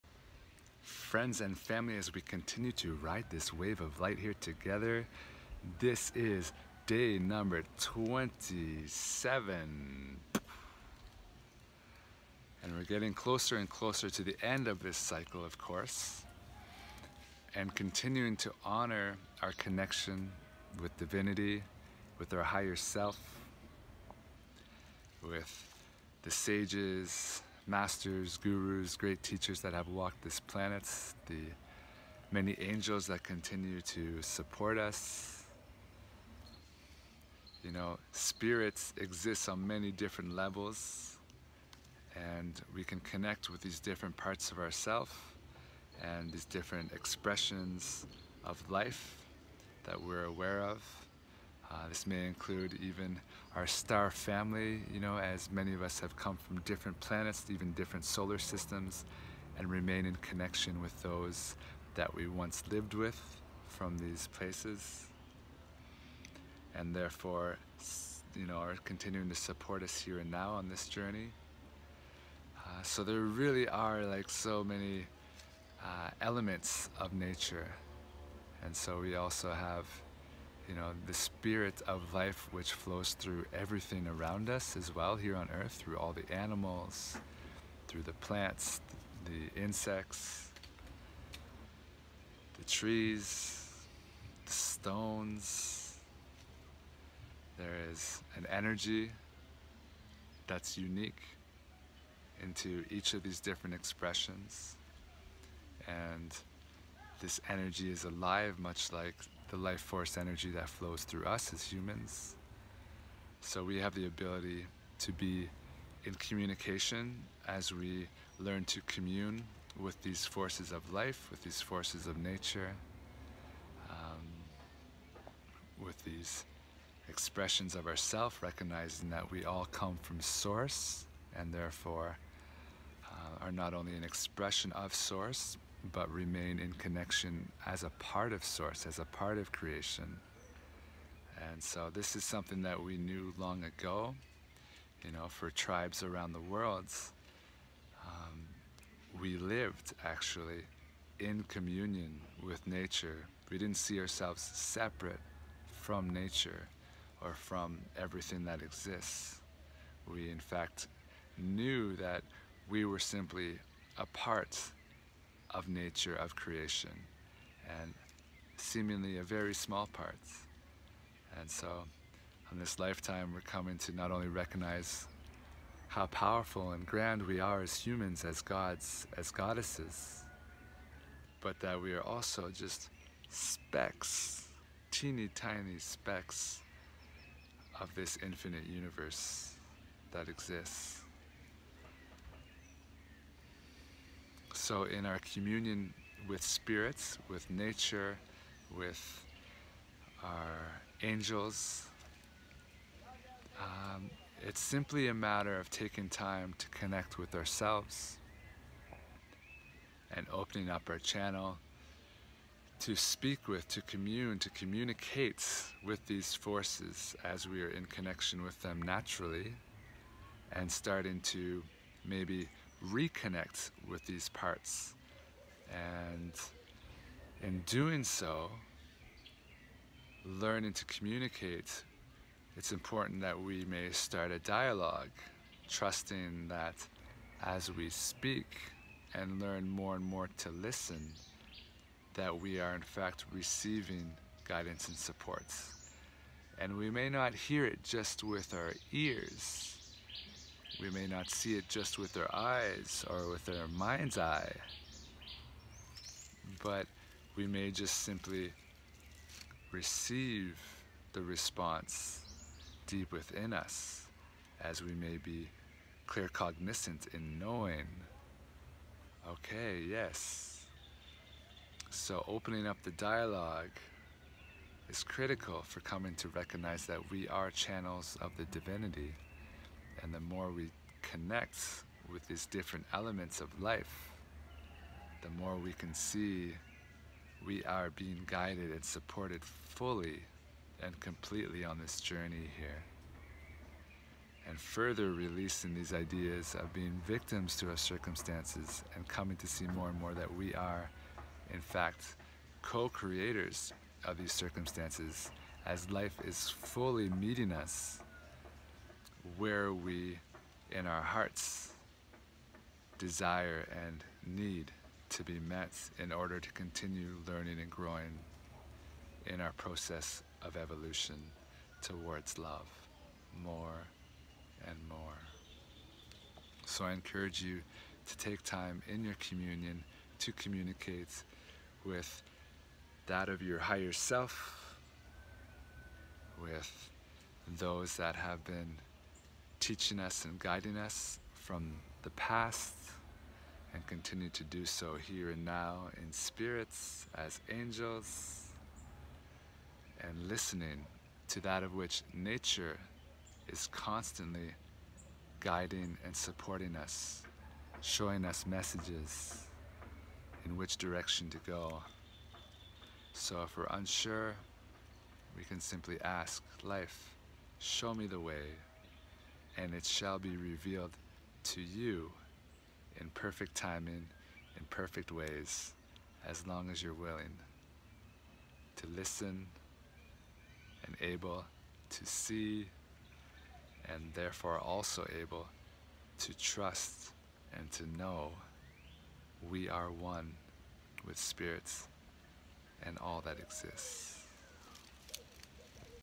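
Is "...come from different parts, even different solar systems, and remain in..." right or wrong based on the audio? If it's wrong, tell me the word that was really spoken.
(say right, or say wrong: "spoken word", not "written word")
wrong: "planets", not "parts".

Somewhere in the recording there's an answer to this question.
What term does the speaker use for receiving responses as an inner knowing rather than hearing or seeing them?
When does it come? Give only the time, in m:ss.
4:26.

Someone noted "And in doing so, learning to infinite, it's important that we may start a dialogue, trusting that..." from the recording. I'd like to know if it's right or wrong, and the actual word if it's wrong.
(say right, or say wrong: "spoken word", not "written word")
wrong: "communicate", not "infinite".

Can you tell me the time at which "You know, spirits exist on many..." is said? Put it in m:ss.
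0:37.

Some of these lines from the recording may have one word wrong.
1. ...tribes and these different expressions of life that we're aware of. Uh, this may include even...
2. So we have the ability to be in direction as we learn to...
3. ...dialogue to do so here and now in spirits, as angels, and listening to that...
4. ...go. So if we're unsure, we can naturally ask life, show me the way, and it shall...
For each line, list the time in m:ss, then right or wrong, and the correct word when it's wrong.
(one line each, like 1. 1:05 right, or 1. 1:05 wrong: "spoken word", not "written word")
1. 0:44 wrong: "ourselves", not "tribes"
2. 1:53 wrong: "communication", not "direction"
3. 5:43 wrong: "continue", not "dialogue"
4. 6:01 wrong: "simply", not "naturally".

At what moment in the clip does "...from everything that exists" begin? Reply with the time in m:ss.
2:37.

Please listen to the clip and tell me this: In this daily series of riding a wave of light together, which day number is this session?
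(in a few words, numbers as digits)
27.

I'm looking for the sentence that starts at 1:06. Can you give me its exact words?
And therefore, you know, are continuing to support us here and now on this journey.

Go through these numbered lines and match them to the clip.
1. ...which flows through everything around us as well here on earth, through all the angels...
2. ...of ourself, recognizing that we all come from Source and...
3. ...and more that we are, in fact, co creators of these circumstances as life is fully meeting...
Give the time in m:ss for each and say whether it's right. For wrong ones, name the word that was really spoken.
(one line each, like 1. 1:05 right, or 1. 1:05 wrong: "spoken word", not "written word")
1. 1:22 wrong: "animals", not "angels"
2. 2:07 right
3. 4:59 right.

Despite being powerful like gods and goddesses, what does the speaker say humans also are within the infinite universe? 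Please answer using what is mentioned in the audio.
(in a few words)
Teeny tiny specks.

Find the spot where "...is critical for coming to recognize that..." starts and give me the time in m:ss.
4:34.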